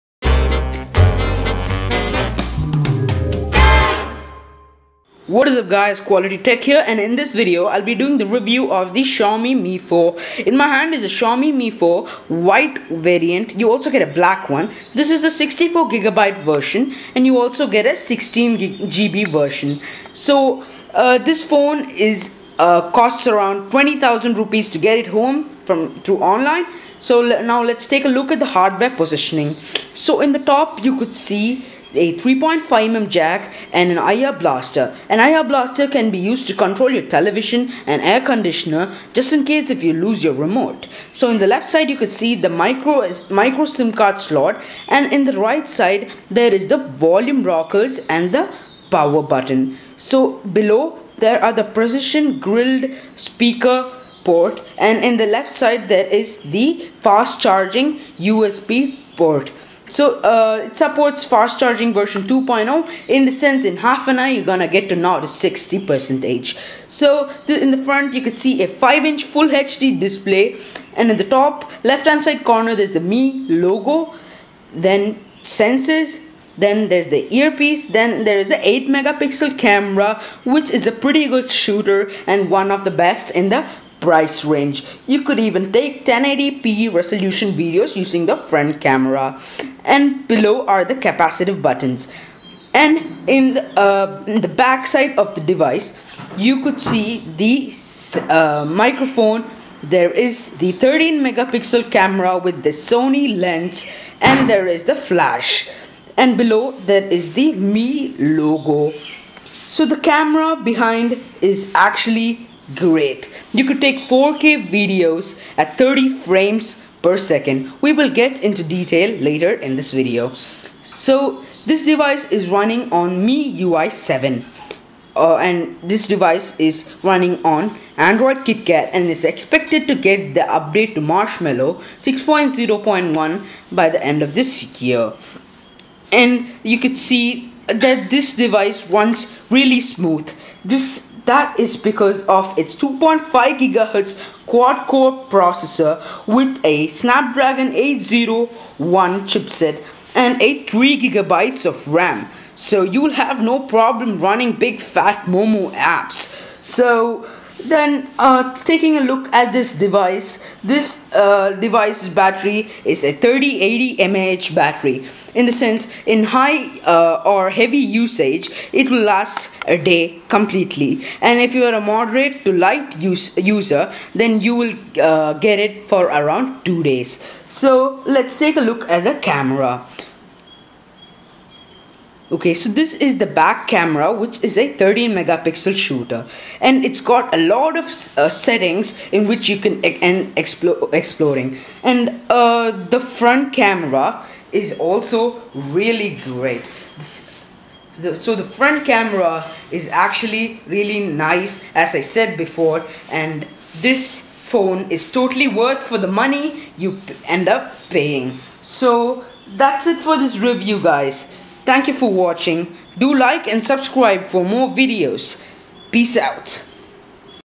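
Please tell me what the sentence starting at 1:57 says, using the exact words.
We will get into detail later in this video.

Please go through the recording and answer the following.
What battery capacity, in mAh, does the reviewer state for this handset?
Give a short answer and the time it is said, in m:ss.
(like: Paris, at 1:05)
3080 mAh, at 2:43.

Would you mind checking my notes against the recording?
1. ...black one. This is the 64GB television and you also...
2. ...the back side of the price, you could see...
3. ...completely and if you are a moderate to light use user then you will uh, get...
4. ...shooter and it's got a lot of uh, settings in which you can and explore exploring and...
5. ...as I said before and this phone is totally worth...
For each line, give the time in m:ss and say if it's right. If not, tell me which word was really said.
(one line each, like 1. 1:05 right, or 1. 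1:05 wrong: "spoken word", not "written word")
1. 0:14 wrong: "version", not "television"
2. 1:34 wrong: "device", not "price"
3. 2:50 right
4. 3:05 right
5. 3:21 right.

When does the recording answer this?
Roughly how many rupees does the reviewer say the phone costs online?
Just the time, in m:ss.
0:23.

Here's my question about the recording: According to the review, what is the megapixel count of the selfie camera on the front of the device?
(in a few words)
8 megapixel.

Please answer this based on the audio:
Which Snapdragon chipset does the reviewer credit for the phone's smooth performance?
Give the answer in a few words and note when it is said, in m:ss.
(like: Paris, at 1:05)
Snapdragon 801, at 2:26.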